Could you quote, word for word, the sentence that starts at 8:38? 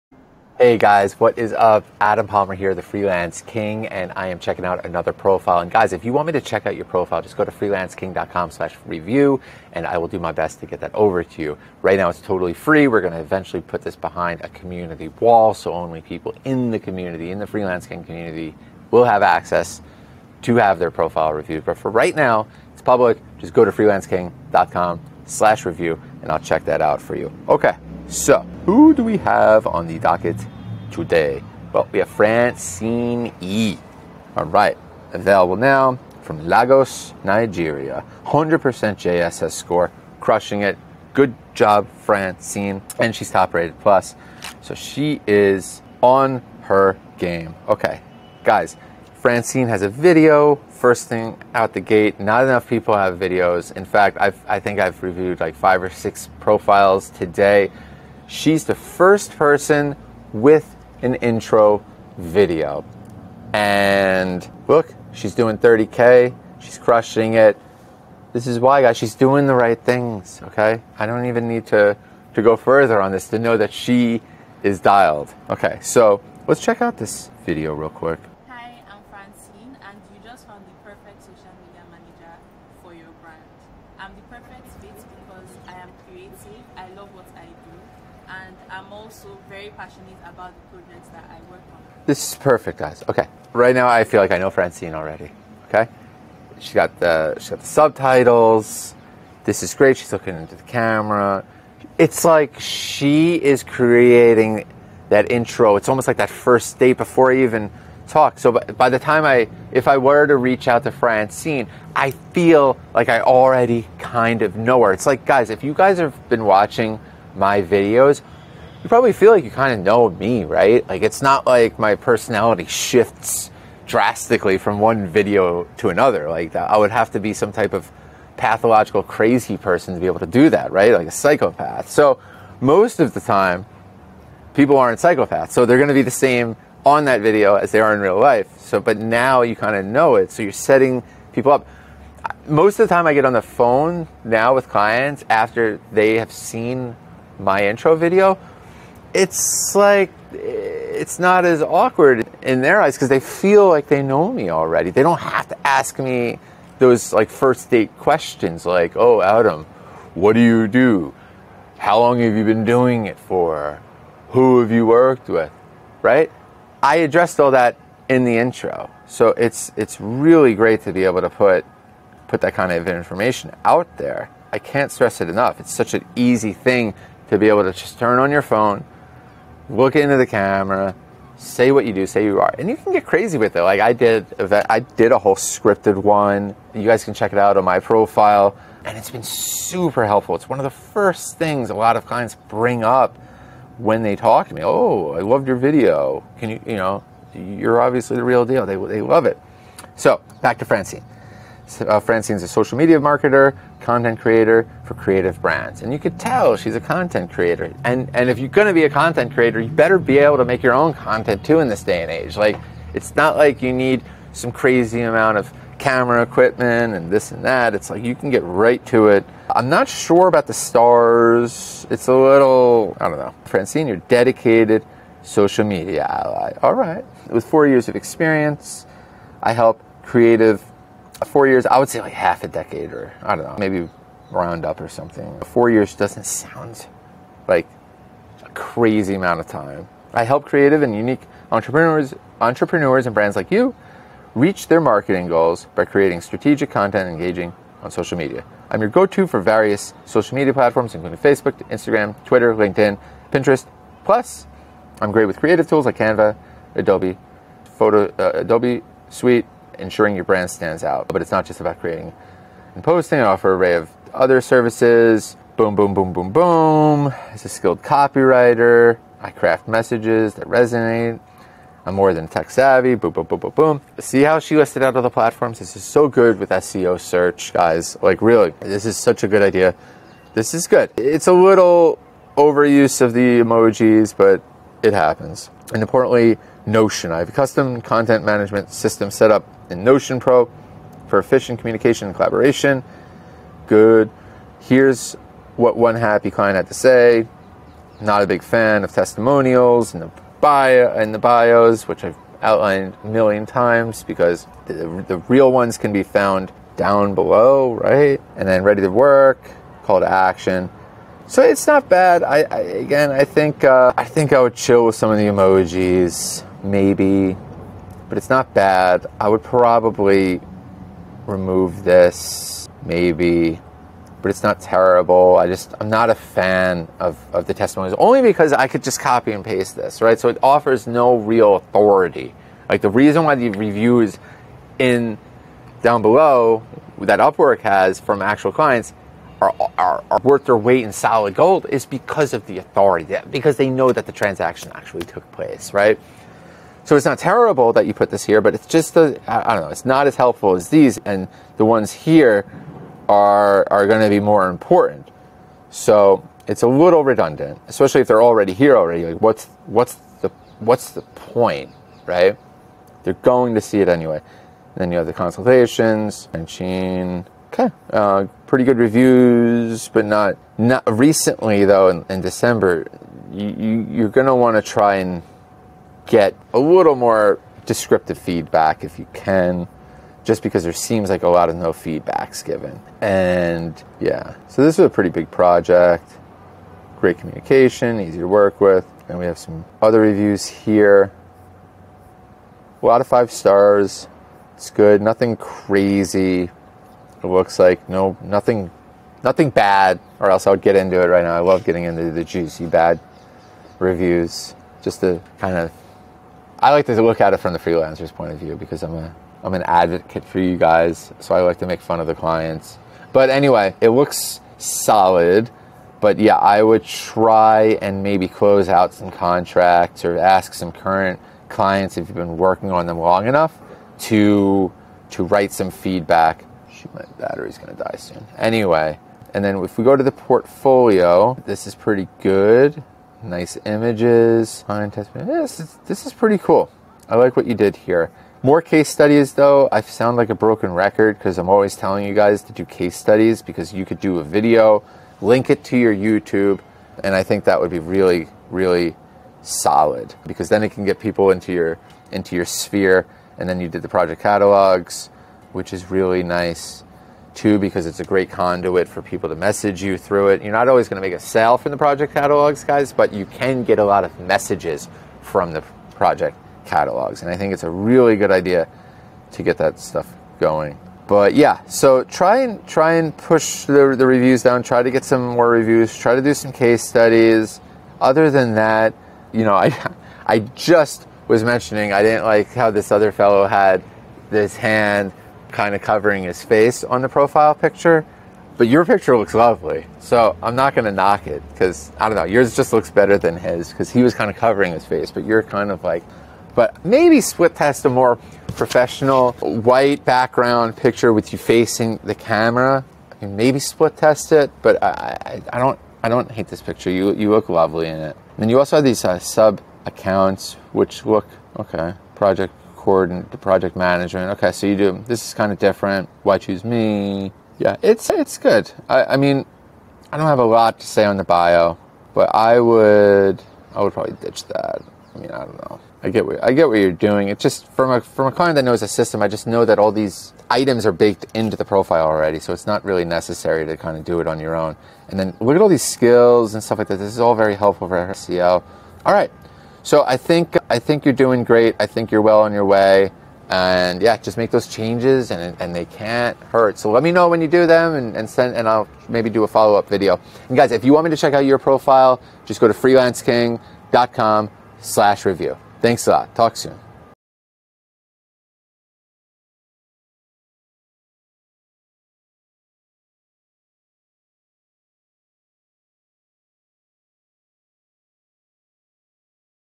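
I, I mean, I don't have a lot to say on the bio, but I would I would probably ditch that.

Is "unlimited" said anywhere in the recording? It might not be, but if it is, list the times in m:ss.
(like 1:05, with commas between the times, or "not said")
not said.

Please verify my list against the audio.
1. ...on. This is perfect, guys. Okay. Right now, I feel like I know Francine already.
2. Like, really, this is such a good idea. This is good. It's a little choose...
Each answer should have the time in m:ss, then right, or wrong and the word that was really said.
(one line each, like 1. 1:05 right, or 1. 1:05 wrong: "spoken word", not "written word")
1. 1:31 right
2. 4:38 wrong: "overuse", not "choose".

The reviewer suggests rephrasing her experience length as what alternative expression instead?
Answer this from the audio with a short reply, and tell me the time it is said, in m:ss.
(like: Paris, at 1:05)
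half a decade, at 3:52.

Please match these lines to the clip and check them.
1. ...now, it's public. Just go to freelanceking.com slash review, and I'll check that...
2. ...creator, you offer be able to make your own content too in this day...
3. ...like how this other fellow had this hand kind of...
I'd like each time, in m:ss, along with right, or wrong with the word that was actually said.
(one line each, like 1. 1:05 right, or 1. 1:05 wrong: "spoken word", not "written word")
1. 0:22 right
2. 3:29 wrong: "better", not "offer"
3. 8:02 right.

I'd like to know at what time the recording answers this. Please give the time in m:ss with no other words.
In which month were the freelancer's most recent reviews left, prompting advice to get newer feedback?
6:12.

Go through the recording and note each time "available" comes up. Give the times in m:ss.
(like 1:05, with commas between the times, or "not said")
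0:35.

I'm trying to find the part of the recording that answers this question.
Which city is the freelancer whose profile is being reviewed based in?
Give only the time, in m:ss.
0:36.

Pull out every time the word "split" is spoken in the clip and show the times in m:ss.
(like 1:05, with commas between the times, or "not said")
8:17, 8:23.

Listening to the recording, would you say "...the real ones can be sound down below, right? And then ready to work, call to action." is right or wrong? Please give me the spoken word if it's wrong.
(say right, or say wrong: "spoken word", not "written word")
wrong: "found", not "sound".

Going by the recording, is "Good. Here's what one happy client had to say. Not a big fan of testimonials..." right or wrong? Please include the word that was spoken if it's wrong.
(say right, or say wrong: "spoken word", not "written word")
right.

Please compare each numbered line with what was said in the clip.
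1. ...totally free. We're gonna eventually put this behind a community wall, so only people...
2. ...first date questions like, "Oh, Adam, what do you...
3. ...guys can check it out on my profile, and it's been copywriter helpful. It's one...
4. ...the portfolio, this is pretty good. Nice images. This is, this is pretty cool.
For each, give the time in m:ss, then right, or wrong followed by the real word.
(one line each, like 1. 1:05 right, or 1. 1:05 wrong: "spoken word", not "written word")
1. 0:12 right
2. 2:37 right
3. 3:06 wrong: "super", not "copywriter"
4. 7:10 right.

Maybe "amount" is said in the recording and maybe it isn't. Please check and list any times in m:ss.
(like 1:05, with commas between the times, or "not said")
3:35, 3:59.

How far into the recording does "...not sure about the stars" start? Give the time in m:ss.
3:39.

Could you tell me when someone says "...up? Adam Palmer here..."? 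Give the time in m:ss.
0:01.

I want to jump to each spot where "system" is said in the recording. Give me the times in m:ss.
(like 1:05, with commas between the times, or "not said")
4:48, 8:48.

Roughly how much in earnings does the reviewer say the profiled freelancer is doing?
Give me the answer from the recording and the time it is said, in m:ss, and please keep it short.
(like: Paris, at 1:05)
30K, at 1:05.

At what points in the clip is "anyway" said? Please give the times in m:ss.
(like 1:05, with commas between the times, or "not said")
6:03, 6:53, 7:08.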